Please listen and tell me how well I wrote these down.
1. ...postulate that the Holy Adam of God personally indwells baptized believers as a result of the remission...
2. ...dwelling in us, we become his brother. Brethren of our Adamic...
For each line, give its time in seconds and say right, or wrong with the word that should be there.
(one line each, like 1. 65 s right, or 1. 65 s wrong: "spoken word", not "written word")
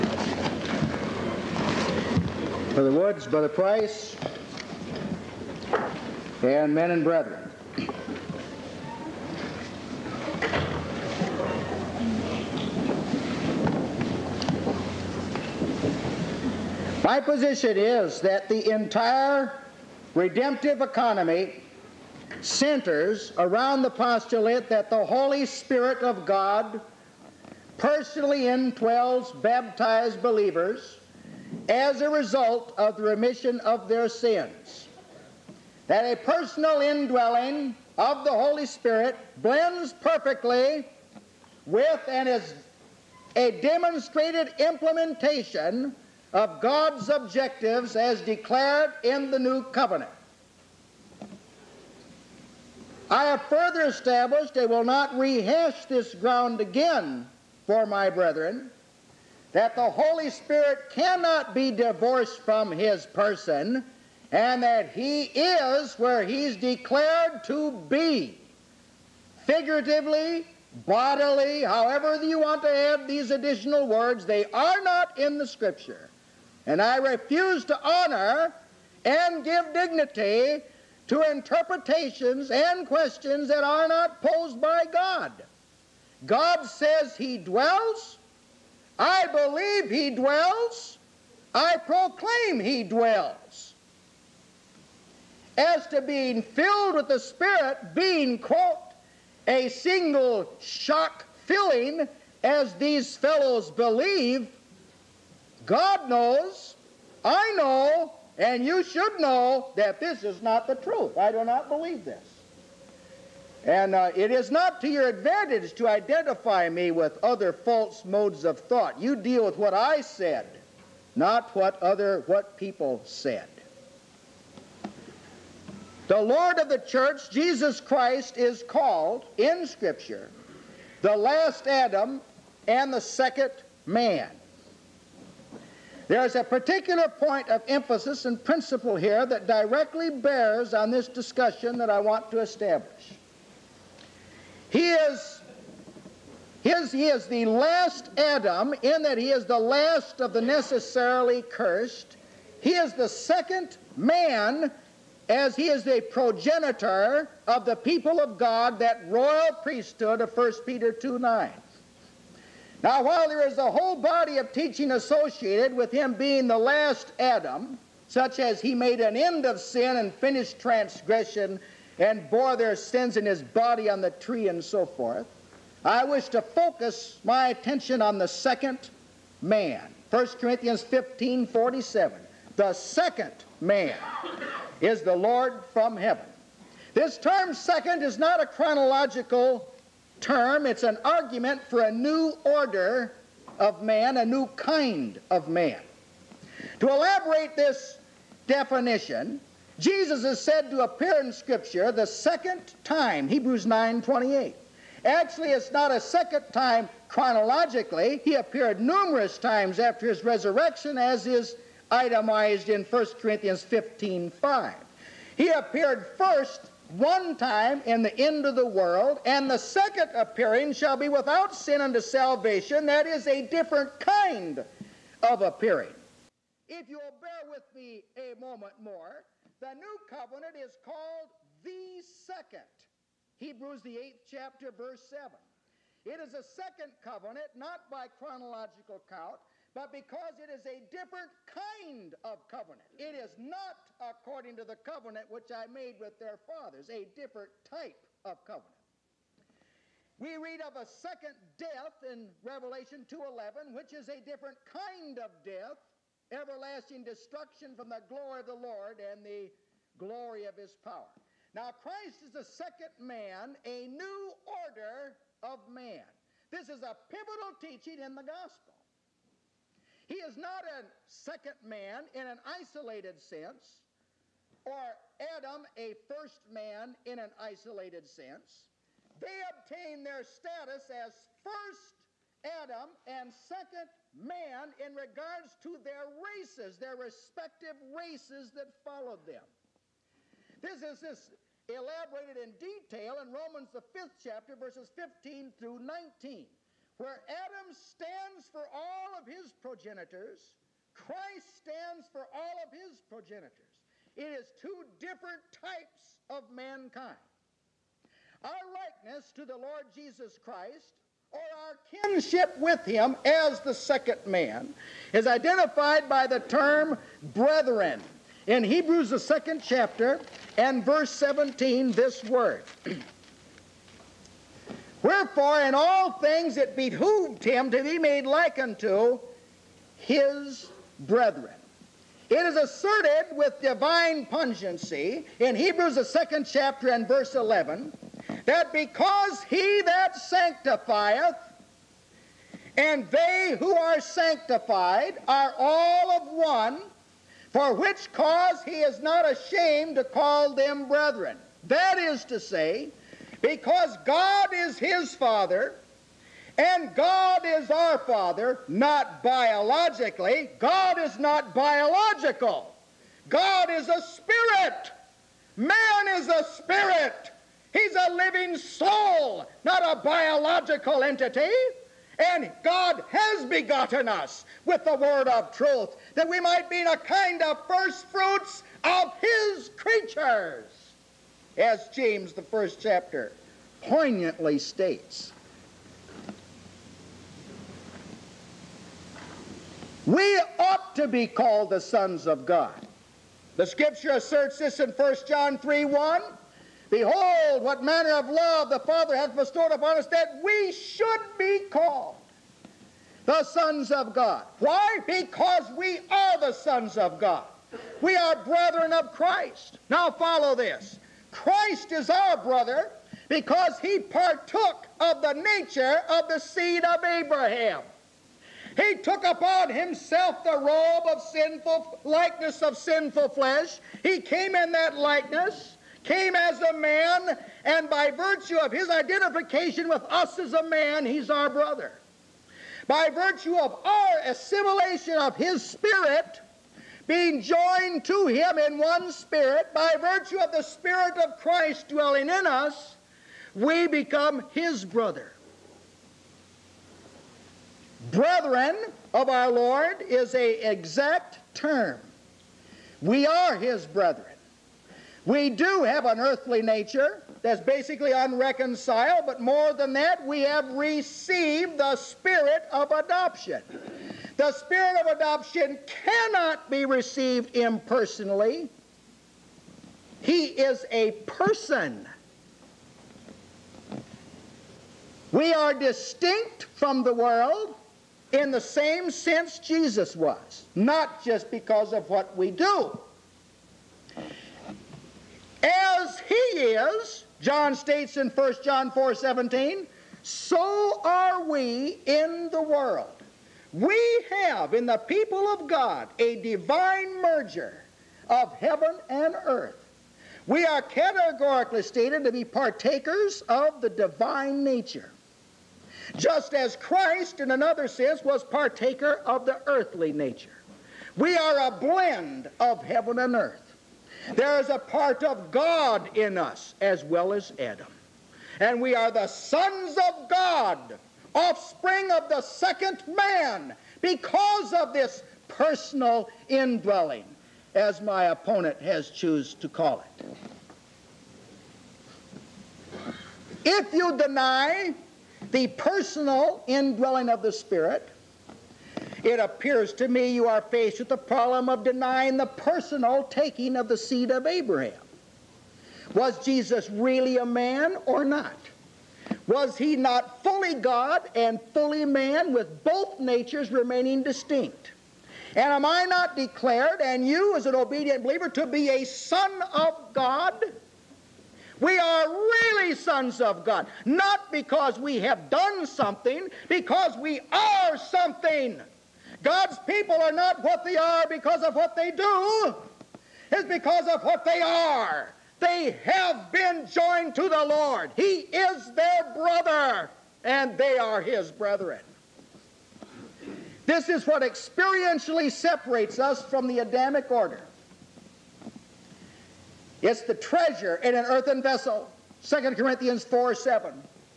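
1. 23 s wrong: "Spirit", not "Adam"
2. 441 s wrong: "Lord", not "Adamic".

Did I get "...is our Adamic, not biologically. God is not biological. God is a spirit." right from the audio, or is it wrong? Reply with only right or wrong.
wrong.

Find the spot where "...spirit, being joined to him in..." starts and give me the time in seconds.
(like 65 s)
435 s.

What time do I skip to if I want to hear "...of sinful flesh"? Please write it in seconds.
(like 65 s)
422 s.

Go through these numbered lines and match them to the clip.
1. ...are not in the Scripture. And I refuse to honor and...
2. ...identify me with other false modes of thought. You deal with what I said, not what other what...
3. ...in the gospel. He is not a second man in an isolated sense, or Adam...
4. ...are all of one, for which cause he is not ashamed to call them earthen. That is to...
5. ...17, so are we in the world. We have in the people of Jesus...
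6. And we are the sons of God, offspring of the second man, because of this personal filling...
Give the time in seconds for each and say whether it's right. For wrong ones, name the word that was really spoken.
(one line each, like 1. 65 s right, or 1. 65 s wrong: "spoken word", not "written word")
1. 74 s right
2. 115 s right
3. 267 s right
4. 345 s wrong: "brethren", not "earthen"
5. 489 s wrong: "God", not "Jesus"
6. 518 s wrong: "indwelling", not "filling".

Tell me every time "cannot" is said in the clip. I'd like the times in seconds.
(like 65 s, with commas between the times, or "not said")
60 s, 466 s.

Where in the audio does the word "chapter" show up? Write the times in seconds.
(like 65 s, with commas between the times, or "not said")
234 s, 294 s, 319 s, 336 s, 382 s.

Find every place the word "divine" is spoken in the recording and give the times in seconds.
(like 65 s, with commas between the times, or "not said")
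333 s, 496 s, 503 s.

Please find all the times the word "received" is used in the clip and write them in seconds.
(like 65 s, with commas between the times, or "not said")
460 s, 466 s.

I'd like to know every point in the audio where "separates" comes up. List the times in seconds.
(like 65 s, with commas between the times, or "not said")
585 s.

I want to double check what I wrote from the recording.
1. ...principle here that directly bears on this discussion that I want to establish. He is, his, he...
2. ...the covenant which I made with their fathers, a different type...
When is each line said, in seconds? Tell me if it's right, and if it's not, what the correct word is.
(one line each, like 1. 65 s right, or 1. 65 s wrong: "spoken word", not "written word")
1. 138 s right
2. 244 s right.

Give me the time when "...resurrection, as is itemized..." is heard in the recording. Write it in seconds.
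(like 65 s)
210 s.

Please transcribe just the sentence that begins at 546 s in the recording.
Was Jesus really a man or not?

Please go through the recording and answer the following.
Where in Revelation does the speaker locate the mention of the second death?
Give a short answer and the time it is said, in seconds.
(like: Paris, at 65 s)
Revelation 2:11, at 252 s.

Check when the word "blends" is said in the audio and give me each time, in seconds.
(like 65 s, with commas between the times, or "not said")
39 s, 511 s.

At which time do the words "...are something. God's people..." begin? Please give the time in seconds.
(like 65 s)
567 s.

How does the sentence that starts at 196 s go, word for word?
To elaborate this definition, Jesus is said to appear in Scripture the second time, Hebrews 9 28.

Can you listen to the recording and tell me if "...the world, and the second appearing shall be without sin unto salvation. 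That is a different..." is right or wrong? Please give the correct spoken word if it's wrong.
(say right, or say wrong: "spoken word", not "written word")
right.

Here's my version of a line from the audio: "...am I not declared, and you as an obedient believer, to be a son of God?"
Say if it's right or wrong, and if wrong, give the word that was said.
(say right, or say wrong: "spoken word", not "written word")
right.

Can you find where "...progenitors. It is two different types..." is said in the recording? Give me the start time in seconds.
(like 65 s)
302 s.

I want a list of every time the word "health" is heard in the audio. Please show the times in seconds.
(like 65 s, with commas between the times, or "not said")
not said.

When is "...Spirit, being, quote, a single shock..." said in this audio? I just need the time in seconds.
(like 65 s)
97 s.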